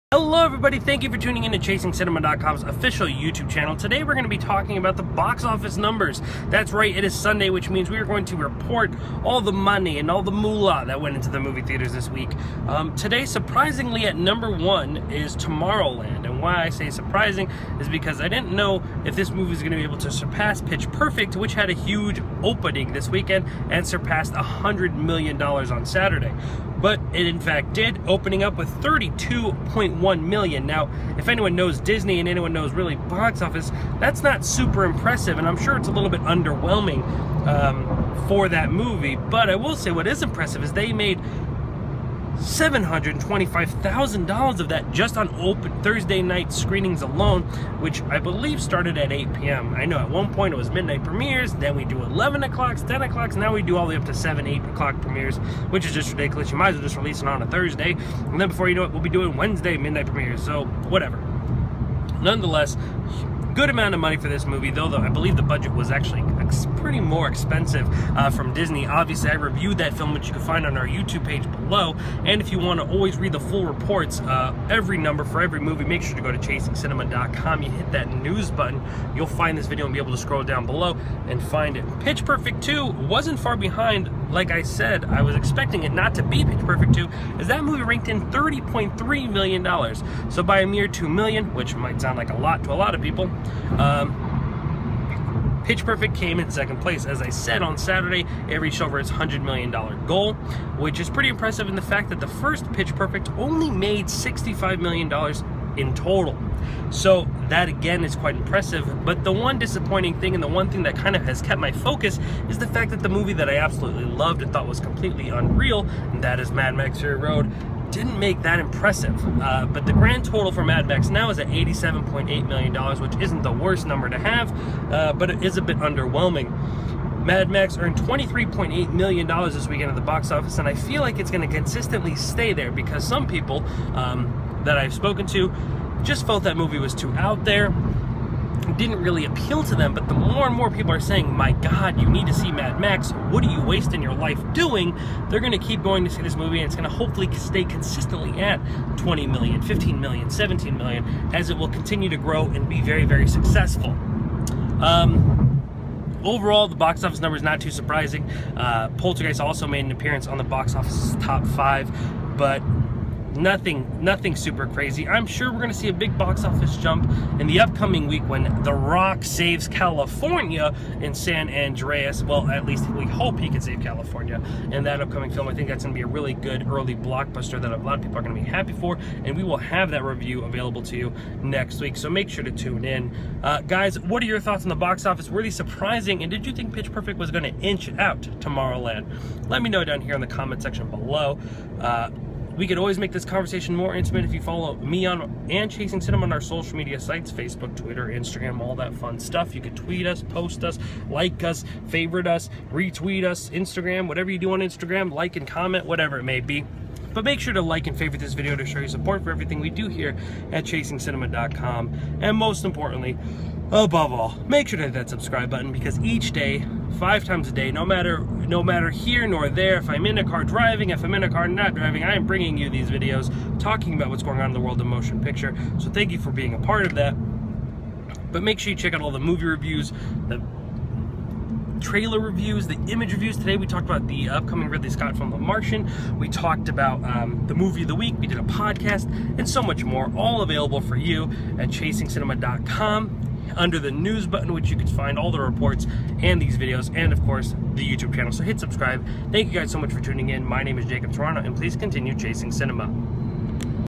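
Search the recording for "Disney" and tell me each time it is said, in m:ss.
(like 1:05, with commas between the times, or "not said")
0:31, 1:08.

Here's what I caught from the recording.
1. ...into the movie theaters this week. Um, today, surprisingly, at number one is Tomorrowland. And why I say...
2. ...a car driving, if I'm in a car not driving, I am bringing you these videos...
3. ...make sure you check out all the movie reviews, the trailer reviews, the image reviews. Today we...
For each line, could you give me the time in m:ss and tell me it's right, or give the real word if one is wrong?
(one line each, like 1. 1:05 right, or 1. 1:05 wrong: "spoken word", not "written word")
1. 0:11 right
2. 3:40 right
3. 3:48 right.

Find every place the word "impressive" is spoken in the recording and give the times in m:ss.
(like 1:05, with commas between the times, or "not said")
0:34, 0:40, 1:41, 1:48, 1:58.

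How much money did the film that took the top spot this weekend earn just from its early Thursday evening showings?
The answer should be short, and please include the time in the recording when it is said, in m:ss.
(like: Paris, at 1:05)
$725,000, at 0:42.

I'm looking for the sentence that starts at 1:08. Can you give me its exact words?
Obviously, I reviewed that film, which you can find on our YouTube page below.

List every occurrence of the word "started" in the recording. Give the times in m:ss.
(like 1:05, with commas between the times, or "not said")
0:48.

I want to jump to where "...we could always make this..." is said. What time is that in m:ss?
3:12.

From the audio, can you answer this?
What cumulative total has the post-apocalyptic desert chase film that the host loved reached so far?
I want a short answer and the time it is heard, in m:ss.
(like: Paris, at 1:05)
$87.8 million, at 2:01.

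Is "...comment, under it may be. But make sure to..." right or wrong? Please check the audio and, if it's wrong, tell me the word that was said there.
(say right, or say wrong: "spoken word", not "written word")
wrong: "whatever", not "under".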